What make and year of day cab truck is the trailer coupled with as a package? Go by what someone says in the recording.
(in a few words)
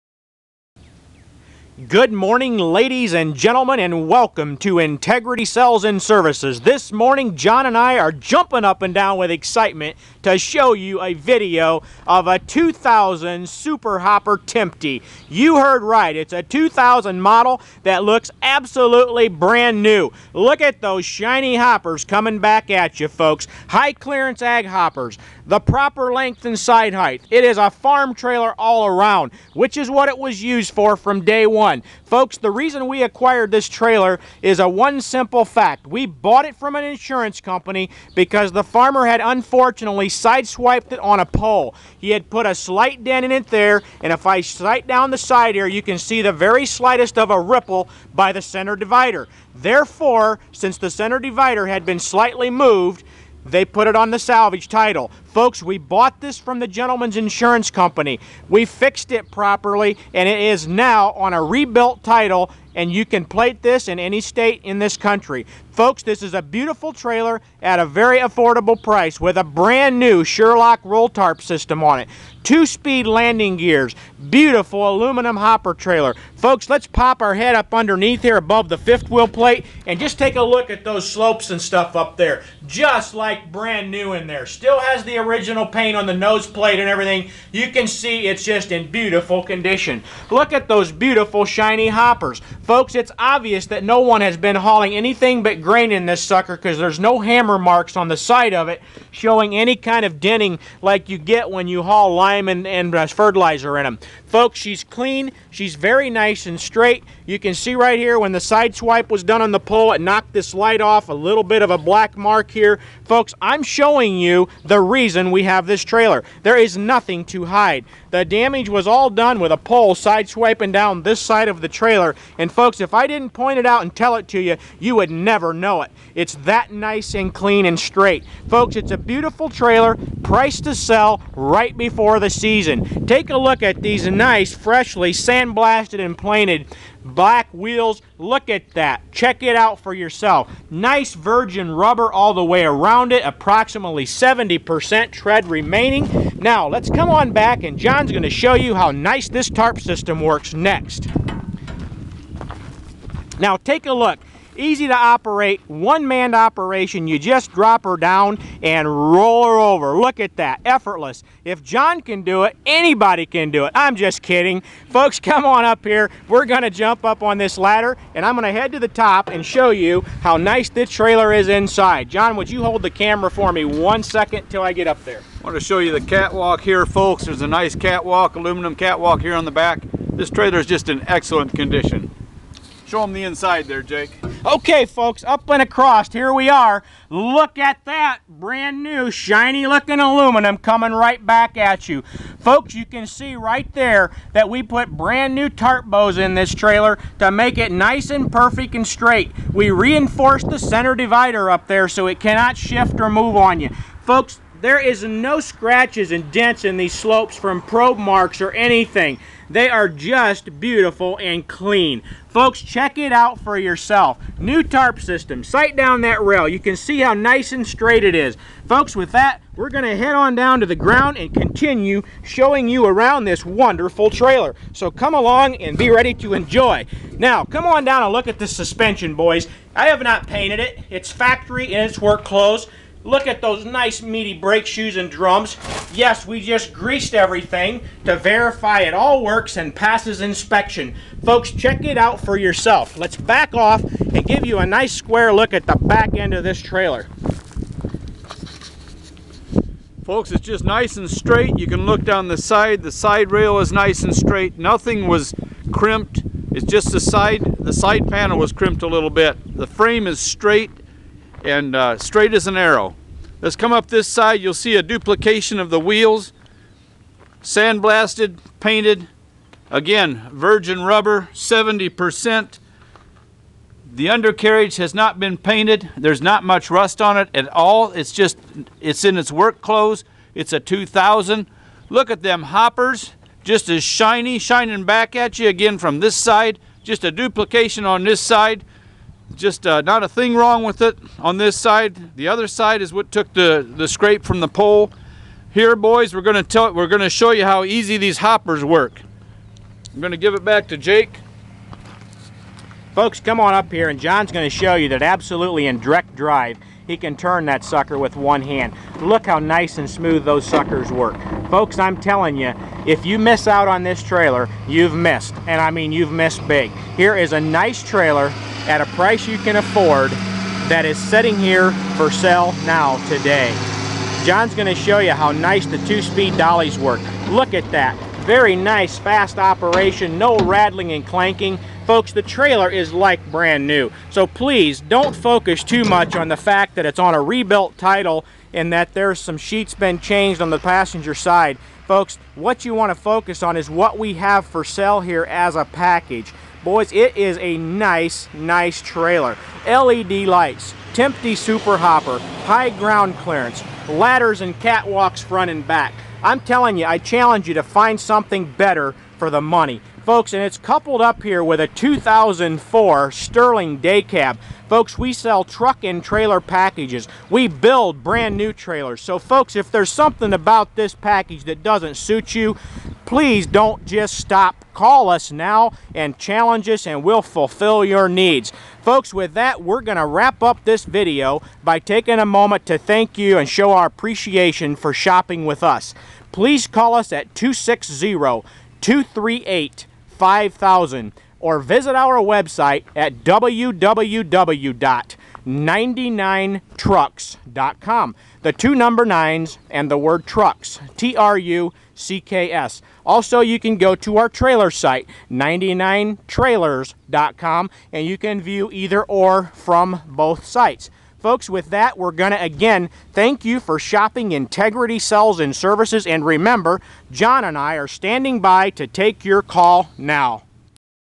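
2004 Sterling.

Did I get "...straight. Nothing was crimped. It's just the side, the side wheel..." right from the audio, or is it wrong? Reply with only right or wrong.
wrong.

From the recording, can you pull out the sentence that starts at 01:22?
Just like brand new in there.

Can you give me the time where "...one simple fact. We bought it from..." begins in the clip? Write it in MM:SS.
00:34.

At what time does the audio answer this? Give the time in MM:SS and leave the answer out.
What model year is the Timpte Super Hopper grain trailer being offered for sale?
00:12.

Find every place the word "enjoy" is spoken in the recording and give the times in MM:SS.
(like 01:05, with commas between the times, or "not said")
03:46.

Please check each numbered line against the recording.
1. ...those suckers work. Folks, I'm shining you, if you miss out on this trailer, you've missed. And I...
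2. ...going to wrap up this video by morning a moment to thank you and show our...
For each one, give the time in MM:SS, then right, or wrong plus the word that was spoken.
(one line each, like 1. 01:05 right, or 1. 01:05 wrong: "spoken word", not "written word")
1. 05:10 wrong: "telling", not "shining"
2. 06:19 wrong: "taking", not "morning".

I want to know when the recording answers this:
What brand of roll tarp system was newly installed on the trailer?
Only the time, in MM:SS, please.
01:10.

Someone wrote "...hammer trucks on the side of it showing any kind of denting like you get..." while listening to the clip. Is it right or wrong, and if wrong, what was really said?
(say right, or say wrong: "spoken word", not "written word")
wrong: "marks", not "trucks".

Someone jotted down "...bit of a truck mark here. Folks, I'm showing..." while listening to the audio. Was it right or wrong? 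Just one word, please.
wrong.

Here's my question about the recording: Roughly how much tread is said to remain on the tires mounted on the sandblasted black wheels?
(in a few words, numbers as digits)
70%.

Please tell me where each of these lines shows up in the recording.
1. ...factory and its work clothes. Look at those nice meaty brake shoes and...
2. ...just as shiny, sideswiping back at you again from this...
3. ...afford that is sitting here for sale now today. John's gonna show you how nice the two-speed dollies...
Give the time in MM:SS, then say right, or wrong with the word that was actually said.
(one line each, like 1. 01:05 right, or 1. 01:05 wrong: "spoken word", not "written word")
1. 03:51 right
2. 04:43 wrong: "shining", not "sideswiping"
3. 05:19 right.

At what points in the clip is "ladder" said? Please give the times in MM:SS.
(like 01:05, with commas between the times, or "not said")
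02:47, 05:53.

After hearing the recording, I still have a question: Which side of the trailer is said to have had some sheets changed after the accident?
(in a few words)
Passenger side.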